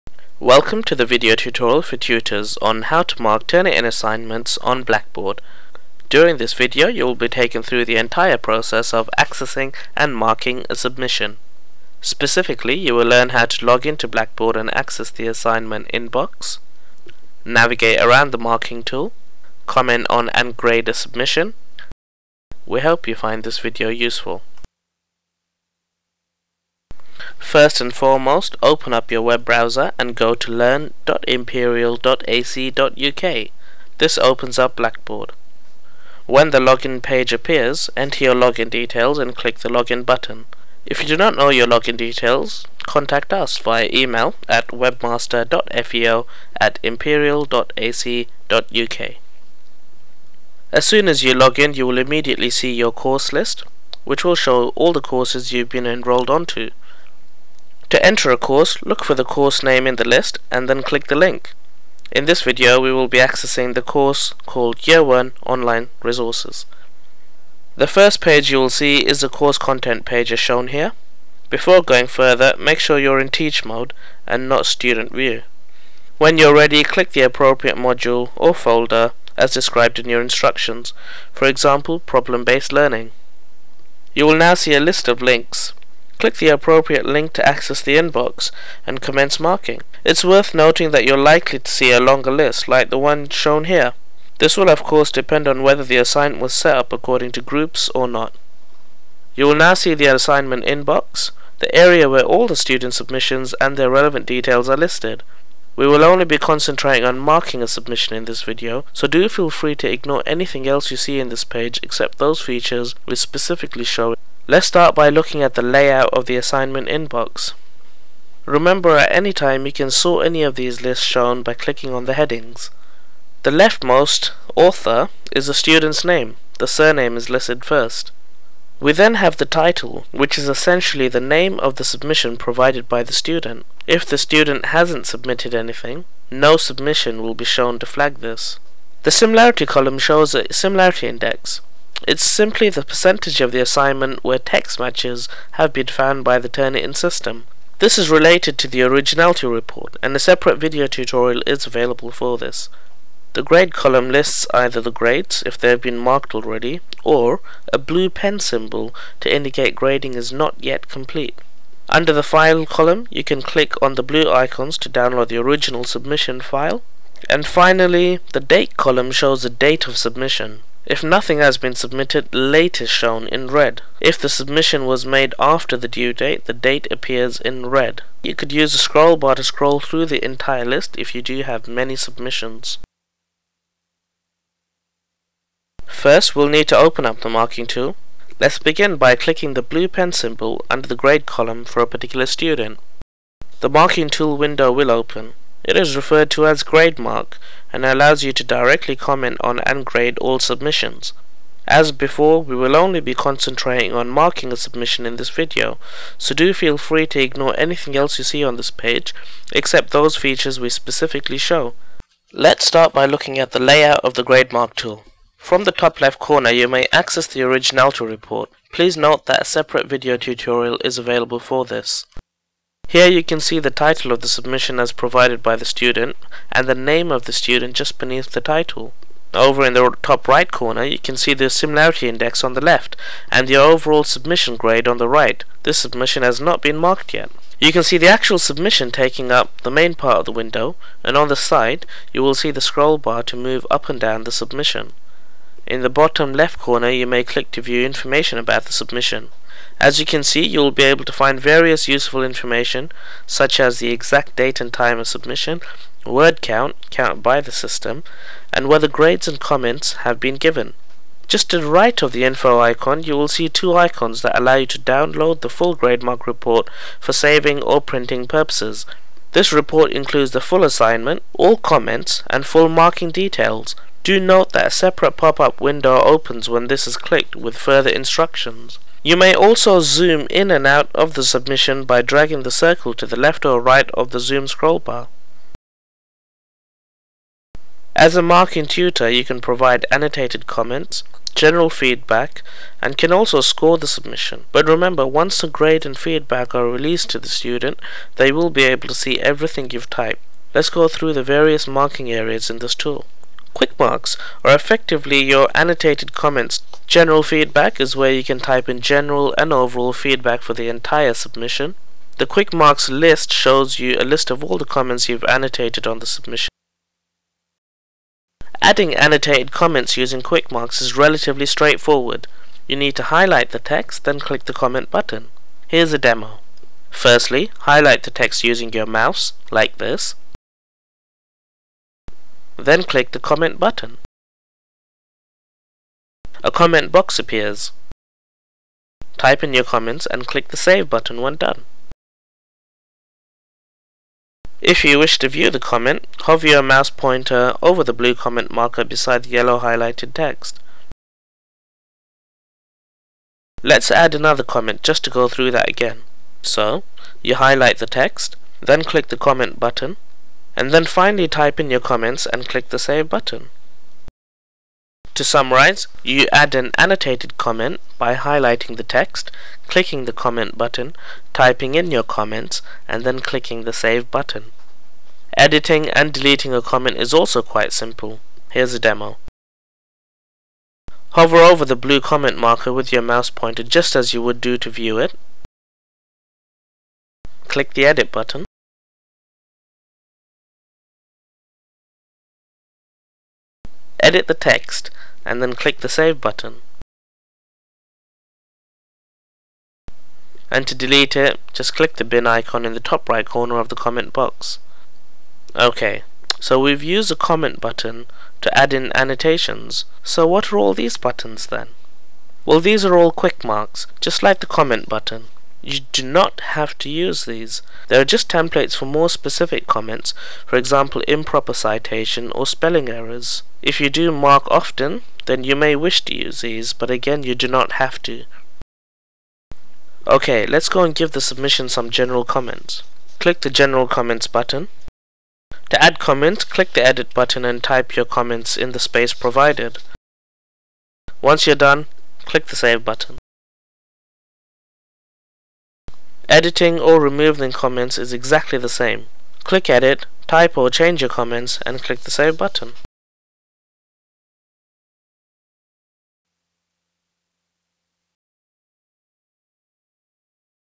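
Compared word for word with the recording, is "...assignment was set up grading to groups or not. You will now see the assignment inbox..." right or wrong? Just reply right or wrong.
wrong.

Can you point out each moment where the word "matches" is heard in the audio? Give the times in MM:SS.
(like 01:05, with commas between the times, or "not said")
02:24.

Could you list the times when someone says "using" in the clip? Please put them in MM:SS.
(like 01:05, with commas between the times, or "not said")
05:19, 05:28.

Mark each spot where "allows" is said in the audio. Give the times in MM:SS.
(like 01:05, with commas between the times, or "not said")
03:17, 04:24.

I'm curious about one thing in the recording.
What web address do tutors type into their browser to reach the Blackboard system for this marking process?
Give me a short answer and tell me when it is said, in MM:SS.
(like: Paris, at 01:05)
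learn.imperial.ac.uk, at 00:30.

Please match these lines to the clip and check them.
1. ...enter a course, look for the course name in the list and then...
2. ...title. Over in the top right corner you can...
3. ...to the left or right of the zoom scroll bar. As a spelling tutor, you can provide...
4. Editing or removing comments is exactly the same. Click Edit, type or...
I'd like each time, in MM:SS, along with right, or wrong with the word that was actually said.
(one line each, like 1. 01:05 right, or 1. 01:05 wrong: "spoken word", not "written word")
1. 00:58 right
2. 03:48 right
3. 04:42 wrong: "marking", not "spelling"
4. 07:26 right.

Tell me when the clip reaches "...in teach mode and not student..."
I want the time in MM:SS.
01:13.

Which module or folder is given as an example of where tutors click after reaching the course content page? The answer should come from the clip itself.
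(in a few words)
problem-based learning.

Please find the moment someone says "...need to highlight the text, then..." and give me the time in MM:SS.
05:22.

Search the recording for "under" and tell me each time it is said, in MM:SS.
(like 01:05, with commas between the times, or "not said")
02:41, 03:10.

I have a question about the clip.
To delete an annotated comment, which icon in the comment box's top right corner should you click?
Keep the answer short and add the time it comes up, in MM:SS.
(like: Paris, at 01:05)
bin icon, at 06:42.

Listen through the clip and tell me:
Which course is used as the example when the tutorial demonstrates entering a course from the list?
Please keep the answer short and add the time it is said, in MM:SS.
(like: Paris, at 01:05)
Year 1 Online Resources, at 01:04.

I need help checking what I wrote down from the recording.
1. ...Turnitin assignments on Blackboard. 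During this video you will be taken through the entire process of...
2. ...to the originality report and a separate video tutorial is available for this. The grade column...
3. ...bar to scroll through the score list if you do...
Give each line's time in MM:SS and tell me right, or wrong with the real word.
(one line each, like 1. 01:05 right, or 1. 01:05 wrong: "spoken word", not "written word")
1. 00:03 right
2. 02:28 right
3. 02:59 wrong: "entire", not "score".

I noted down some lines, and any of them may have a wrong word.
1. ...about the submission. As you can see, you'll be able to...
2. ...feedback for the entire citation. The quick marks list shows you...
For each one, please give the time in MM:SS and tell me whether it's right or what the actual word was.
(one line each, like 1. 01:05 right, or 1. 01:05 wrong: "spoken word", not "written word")
1. 04:08 right
2. 05:09 wrong: "submission", not "citation".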